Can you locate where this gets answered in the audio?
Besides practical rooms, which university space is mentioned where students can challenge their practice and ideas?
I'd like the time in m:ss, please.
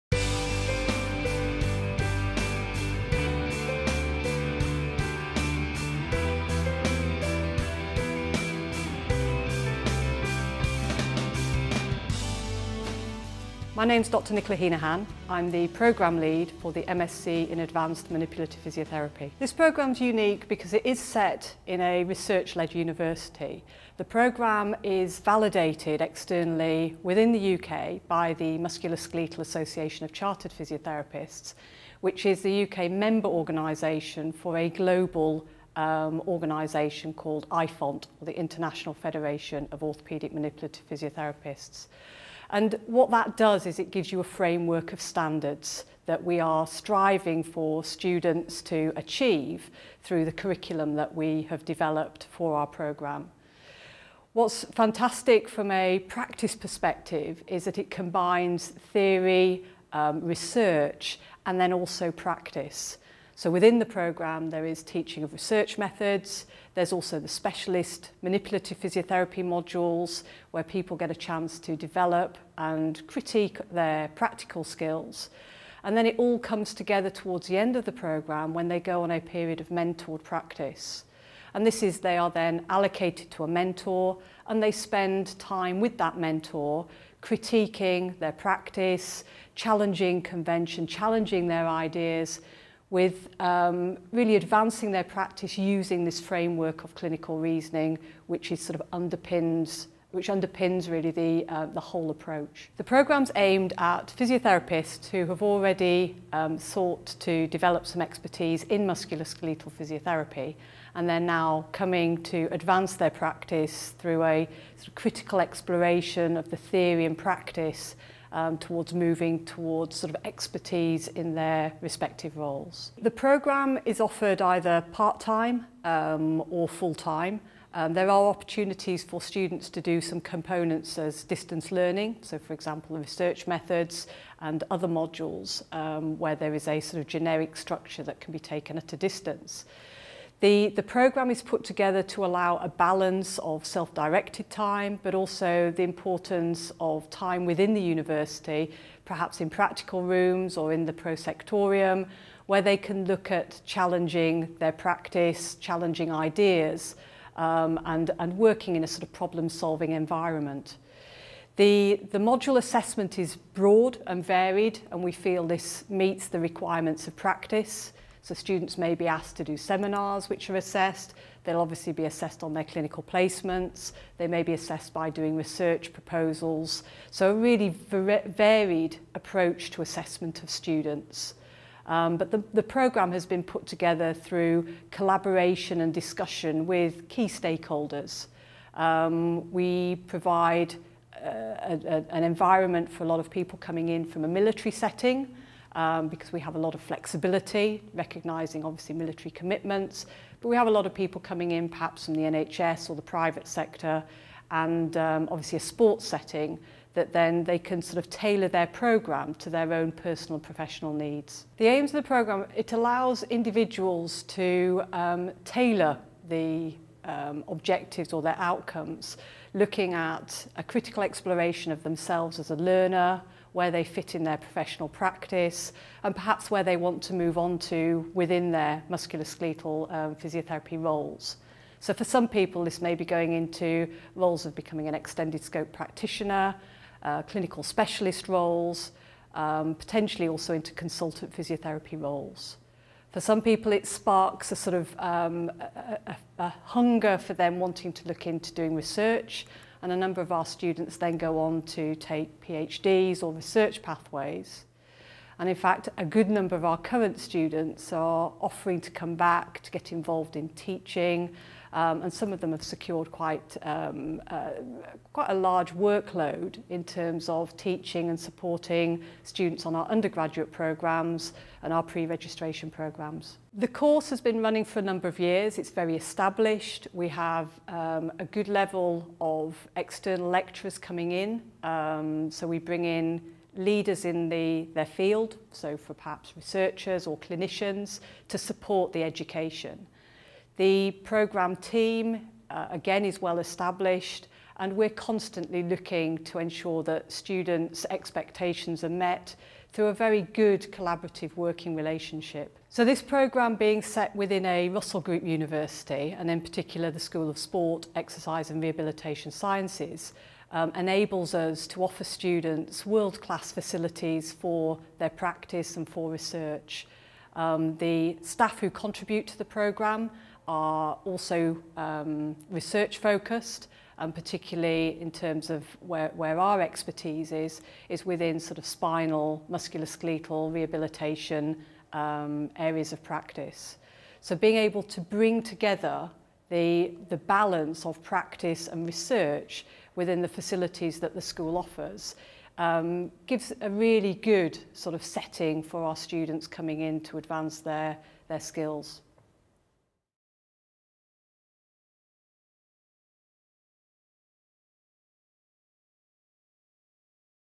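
2:30.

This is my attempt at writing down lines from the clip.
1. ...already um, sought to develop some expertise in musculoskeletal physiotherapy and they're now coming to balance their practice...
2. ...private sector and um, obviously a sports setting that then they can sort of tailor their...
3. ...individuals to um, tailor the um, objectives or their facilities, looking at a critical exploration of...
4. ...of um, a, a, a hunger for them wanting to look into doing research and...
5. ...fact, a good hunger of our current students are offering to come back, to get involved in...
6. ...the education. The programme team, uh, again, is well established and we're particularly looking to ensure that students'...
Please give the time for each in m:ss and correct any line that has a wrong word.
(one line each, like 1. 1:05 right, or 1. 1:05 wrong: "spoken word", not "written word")
1. 1:45 wrong: "advance", not "balance"
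2. 3:23 right
3. 3:33 wrong: "outcomes", not "facilities"
4. 4:04 right
5. 4:15 wrong: "number", not "hunger"
6. 4:48 wrong: "constantly", not "particularly".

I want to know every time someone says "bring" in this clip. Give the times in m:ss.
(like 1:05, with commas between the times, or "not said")
4:42, 5:35.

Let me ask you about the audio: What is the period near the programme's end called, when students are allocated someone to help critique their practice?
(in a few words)
mentored practice.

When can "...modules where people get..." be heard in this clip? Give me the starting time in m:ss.
1:09.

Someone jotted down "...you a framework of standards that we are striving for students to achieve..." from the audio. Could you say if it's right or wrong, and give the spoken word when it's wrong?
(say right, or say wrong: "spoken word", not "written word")
right.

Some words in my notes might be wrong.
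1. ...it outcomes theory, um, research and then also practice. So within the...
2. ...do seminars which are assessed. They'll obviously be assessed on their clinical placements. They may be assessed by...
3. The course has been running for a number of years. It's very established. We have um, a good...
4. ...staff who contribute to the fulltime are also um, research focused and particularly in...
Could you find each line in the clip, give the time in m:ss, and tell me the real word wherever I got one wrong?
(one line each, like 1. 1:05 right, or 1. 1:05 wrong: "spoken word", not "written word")
1. 0:57 wrong: "combines", not "outcomes"
2. 2:49 right
3. 4:33 right
4. 5:18 wrong: "programme", not "fulltime".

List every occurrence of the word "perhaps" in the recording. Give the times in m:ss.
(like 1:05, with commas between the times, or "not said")
2:29, 3:21, 3:46, 4:45.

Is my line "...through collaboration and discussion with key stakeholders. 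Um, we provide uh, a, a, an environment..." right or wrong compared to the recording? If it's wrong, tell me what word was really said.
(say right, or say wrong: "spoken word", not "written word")
right.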